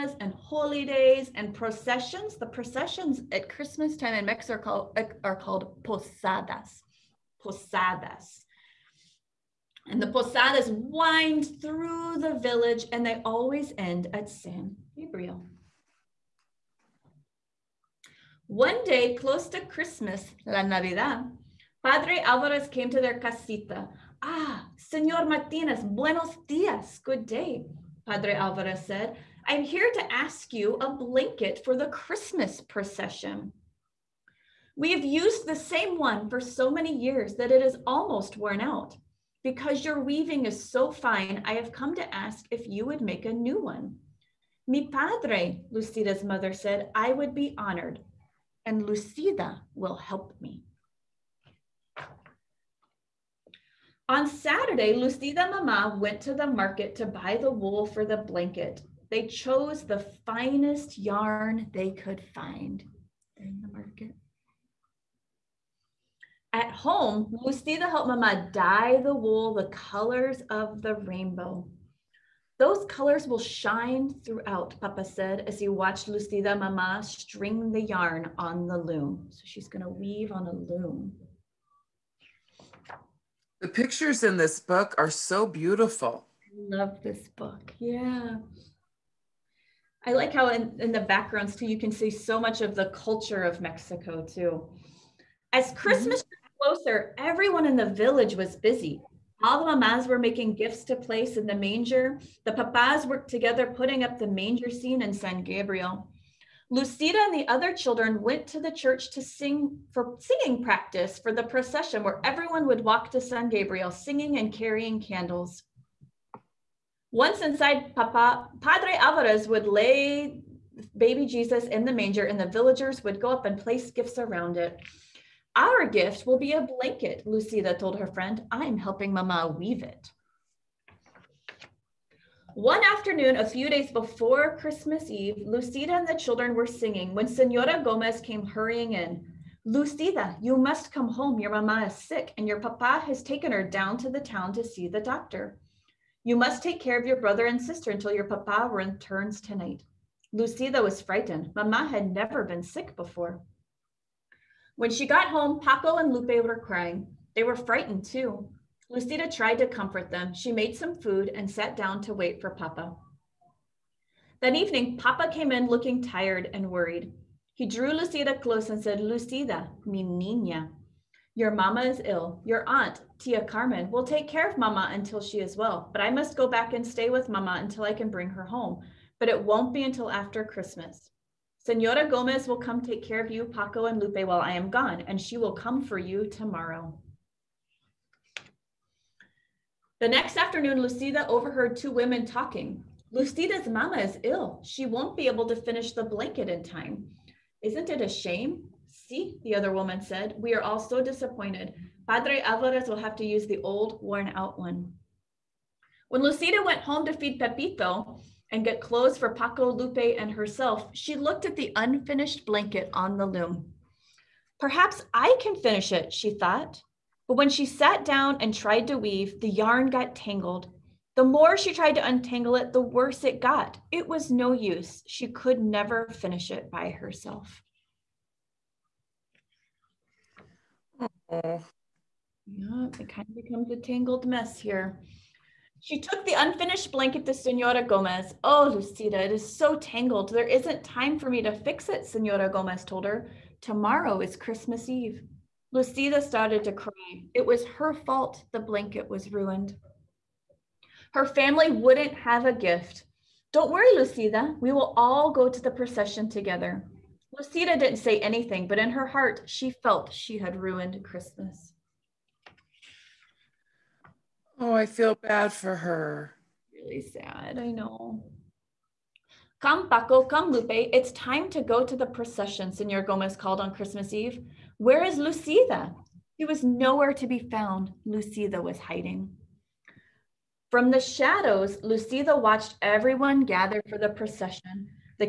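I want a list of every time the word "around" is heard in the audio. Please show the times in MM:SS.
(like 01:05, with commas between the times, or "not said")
02:04.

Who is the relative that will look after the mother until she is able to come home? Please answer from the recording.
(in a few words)
Tia Carmen.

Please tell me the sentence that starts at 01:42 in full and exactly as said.
The papas worked together putting up the manger scene in San Gabriel.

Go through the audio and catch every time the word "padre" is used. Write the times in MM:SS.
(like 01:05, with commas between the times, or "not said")
00:21, 00:28, 00:44, 01:58, 03:22.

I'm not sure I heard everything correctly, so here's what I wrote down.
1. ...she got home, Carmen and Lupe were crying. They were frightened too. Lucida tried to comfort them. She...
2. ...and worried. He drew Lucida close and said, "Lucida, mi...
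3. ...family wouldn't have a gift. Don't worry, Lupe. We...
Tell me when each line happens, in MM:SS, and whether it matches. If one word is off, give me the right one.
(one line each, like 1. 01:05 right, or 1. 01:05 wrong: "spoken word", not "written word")
1. 02:34 wrong: "Paco", not "Carmen"
2. 02:46 right
3. 04:11 wrong: "Lucida", not "Lupe".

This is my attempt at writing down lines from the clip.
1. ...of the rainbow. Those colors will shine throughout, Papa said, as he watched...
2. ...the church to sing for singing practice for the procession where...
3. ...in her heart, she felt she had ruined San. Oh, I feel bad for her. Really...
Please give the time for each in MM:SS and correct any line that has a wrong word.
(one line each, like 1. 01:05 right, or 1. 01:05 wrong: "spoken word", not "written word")
1. 01:10 right
2. 01:48 right
3. 04:18 wrong: "Christmas", not "San".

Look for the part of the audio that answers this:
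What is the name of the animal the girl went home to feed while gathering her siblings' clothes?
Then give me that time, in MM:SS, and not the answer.
03:27.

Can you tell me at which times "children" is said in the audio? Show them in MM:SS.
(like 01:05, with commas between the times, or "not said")
01:47, 02:16.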